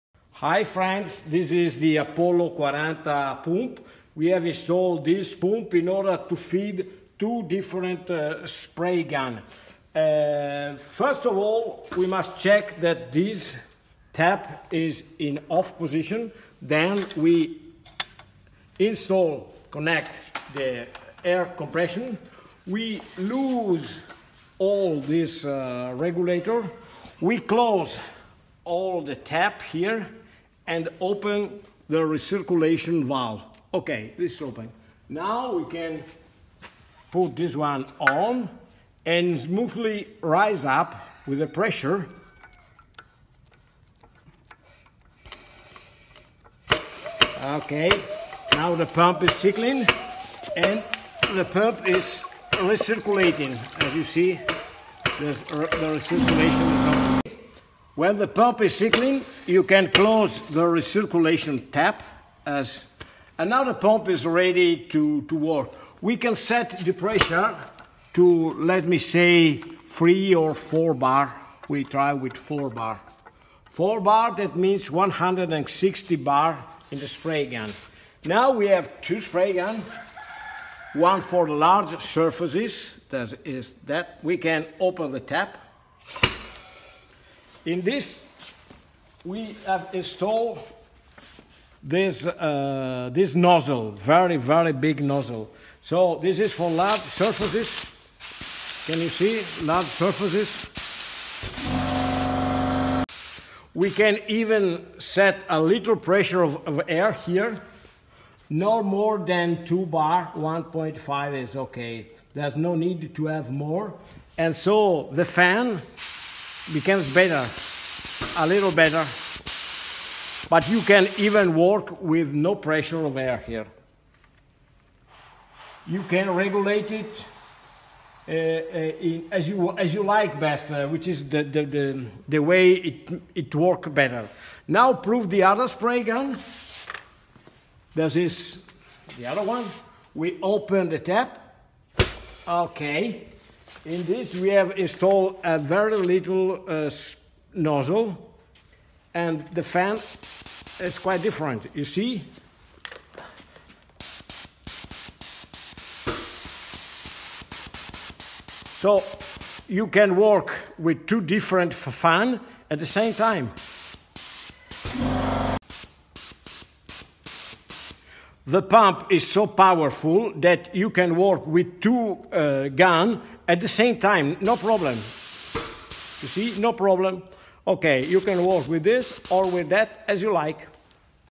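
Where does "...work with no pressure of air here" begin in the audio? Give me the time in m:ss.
2:01.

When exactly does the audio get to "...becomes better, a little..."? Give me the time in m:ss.
1:56.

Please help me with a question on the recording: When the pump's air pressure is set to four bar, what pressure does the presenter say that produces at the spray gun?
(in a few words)
160 bar.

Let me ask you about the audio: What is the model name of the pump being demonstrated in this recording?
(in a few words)
Apollo 40.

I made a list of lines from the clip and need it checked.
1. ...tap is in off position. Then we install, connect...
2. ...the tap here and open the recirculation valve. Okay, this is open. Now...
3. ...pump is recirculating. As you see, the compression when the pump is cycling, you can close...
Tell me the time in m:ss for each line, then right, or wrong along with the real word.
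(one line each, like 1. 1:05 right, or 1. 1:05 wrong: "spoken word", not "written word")
1. 0:14 right
2. 0:29 right
3. 0:51 wrong: "recirculation", not "compression".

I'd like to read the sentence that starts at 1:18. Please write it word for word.
Now we have two spray guns.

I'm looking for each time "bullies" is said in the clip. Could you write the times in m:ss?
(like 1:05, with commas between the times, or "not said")
not said.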